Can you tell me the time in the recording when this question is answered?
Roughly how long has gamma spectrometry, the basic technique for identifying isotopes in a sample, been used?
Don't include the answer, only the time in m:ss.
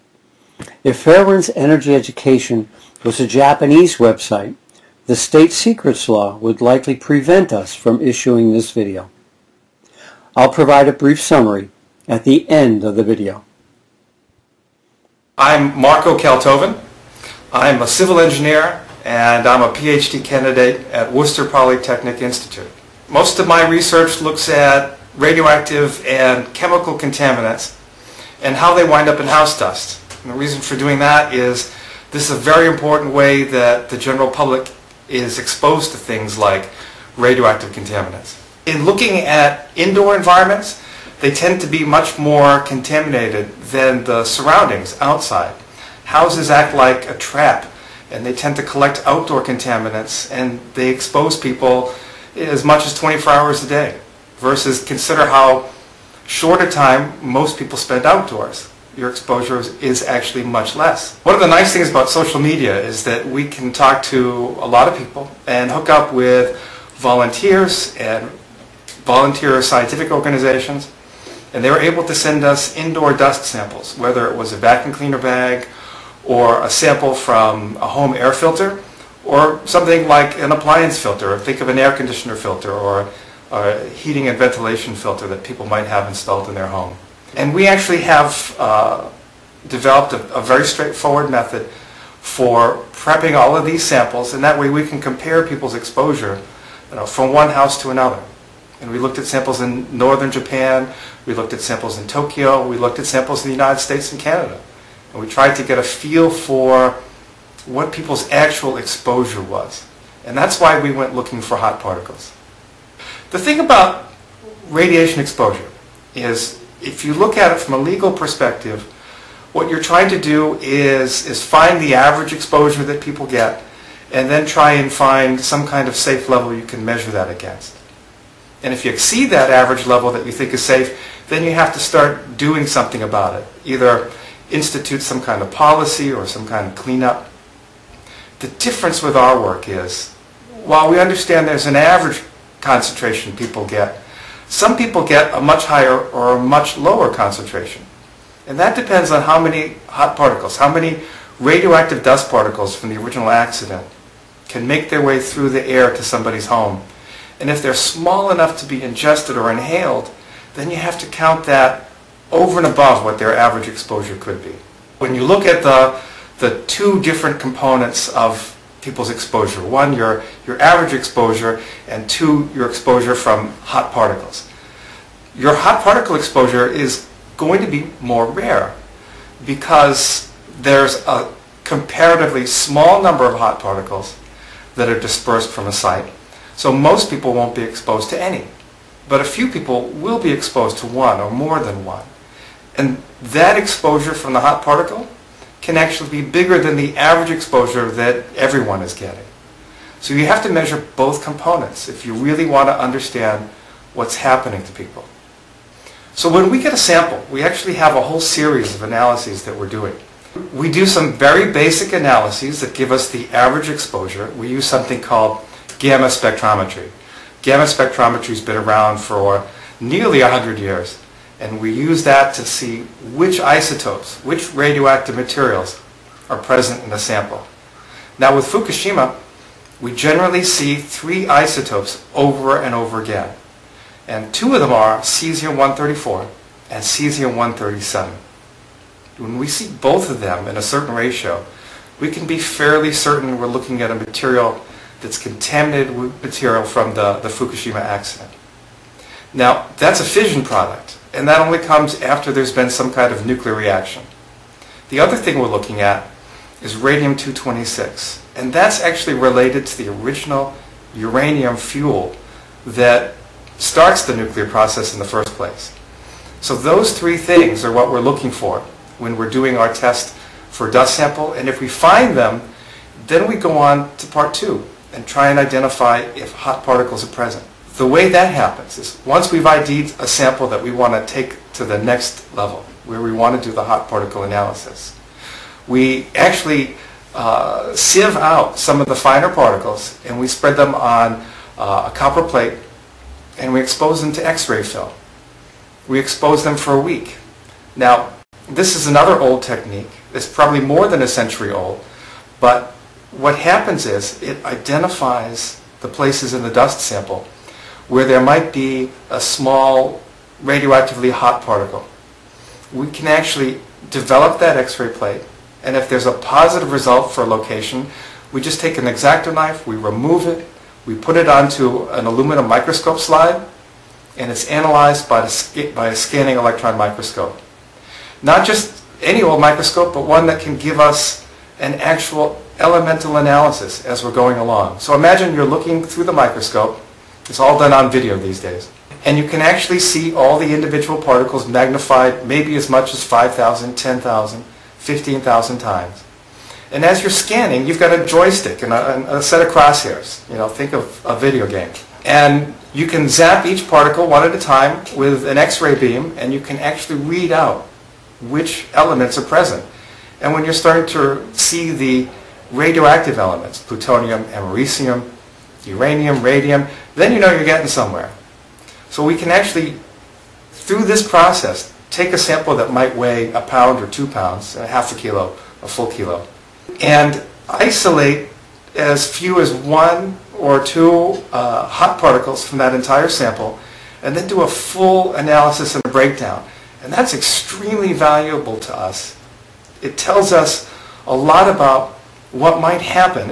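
3:39.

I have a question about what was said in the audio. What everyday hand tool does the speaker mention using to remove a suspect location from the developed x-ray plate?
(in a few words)
X-Acto knife.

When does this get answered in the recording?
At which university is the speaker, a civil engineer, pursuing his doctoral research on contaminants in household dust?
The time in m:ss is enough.
0:21.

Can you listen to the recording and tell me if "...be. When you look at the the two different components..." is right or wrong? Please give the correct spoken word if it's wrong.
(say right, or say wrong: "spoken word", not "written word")
right.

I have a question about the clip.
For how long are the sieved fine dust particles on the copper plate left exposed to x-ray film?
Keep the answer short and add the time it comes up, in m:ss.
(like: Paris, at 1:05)
A week, at 4:56.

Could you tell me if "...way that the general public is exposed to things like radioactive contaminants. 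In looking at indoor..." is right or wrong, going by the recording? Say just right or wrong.
right.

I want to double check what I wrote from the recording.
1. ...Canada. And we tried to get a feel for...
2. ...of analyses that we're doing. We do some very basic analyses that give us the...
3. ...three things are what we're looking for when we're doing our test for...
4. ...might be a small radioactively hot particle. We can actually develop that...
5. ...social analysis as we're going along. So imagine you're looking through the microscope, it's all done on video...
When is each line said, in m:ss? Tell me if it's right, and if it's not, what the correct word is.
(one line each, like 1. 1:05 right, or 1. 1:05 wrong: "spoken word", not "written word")
1. 1:44 right
2. 3:28 right
3. 4:26 right
4. 5:08 right
5. 5:32 wrong: "elemental", not "social".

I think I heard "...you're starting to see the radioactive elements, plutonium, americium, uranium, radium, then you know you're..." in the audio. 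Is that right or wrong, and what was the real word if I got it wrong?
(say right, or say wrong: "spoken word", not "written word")
right.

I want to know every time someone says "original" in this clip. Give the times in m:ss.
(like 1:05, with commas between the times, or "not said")
2:32, 4:19.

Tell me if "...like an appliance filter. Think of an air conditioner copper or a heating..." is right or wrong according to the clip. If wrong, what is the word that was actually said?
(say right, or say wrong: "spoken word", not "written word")
wrong: "filter", not "copper".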